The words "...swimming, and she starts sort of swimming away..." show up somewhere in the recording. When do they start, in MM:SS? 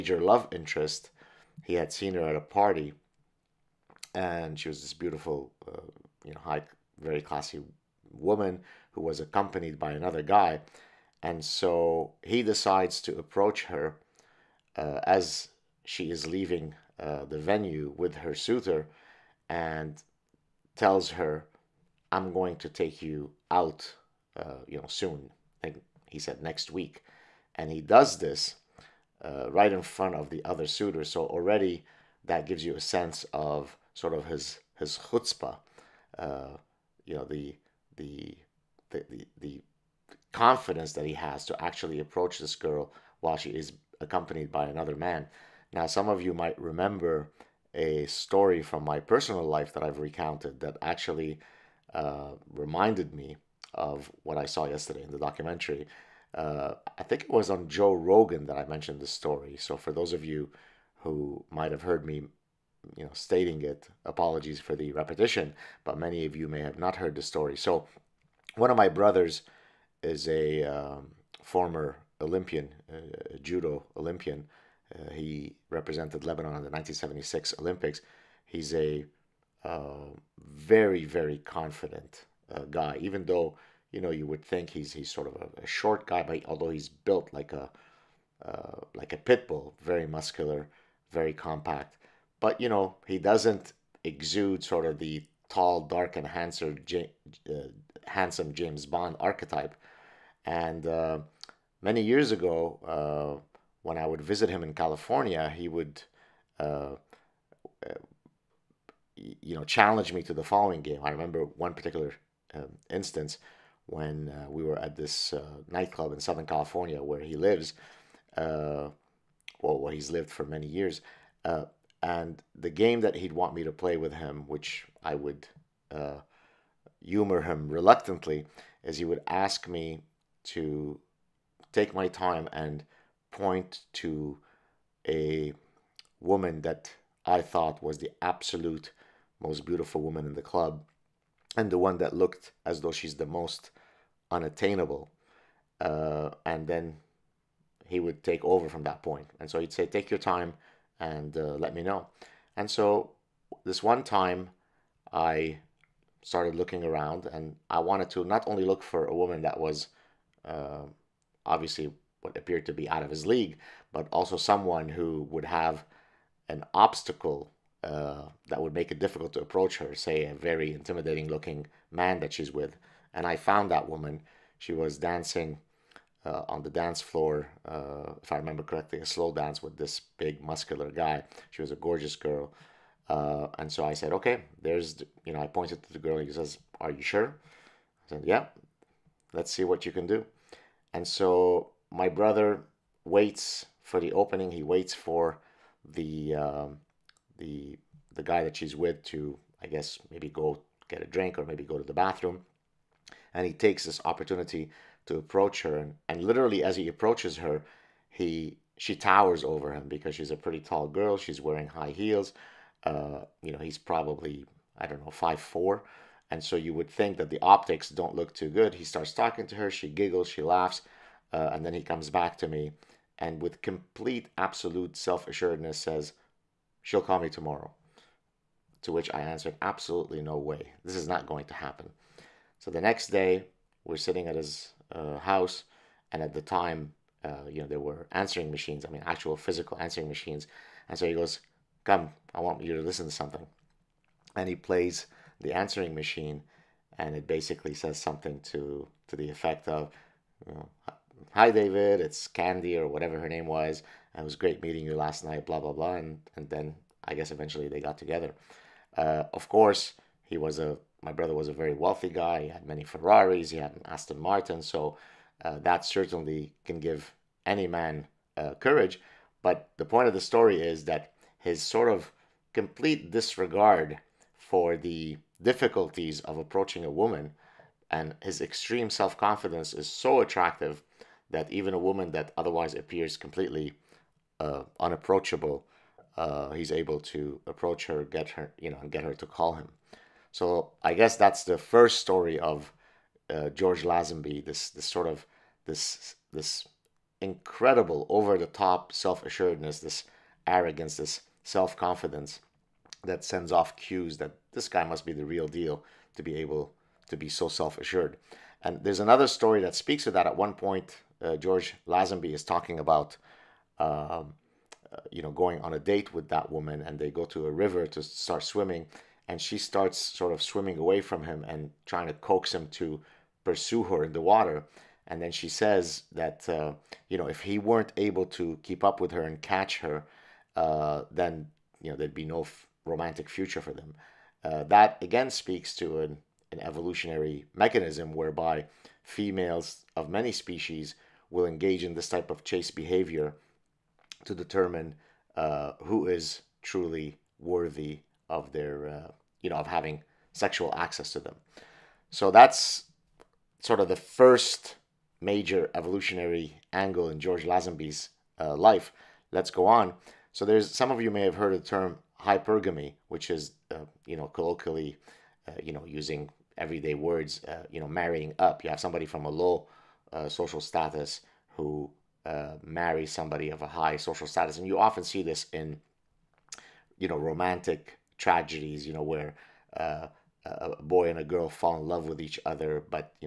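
05:18.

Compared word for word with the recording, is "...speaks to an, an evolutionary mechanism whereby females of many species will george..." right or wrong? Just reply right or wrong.
wrong.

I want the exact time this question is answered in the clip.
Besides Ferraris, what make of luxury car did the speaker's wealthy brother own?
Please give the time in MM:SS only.
04:23.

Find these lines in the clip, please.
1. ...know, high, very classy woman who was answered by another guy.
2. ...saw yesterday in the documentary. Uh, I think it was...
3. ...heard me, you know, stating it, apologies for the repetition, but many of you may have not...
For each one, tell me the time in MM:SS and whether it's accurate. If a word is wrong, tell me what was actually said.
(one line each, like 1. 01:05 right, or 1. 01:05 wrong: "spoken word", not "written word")
1. 00:06 wrong: "accompanied", not "answered"
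2. 00:54 right
3. 01:01 right.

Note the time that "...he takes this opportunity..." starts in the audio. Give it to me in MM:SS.
03:23.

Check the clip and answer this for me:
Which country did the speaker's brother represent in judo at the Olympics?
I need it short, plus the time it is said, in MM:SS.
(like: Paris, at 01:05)
Lebanon, at 01:16.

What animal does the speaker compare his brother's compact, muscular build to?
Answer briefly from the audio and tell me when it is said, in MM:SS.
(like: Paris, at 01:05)
pit bull, at 01:29.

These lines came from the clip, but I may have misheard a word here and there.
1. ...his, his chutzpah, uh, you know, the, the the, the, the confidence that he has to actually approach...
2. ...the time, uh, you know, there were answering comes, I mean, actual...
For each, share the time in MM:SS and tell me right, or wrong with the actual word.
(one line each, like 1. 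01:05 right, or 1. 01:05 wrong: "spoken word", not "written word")
1. 00:34 right
2. 03:56 wrong: "machines", not "comes".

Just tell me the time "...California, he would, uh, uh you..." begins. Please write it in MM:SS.
01:44.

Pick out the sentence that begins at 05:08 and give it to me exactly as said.
And there's another story that speaks to that.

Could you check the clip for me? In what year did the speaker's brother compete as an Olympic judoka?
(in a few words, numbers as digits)
1976.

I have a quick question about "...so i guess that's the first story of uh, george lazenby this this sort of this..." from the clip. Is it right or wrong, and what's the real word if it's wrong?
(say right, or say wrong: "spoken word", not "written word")
right.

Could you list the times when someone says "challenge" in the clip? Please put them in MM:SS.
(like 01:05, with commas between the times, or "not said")
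01:49.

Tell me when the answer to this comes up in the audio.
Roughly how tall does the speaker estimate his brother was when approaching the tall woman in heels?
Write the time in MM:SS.
03:35.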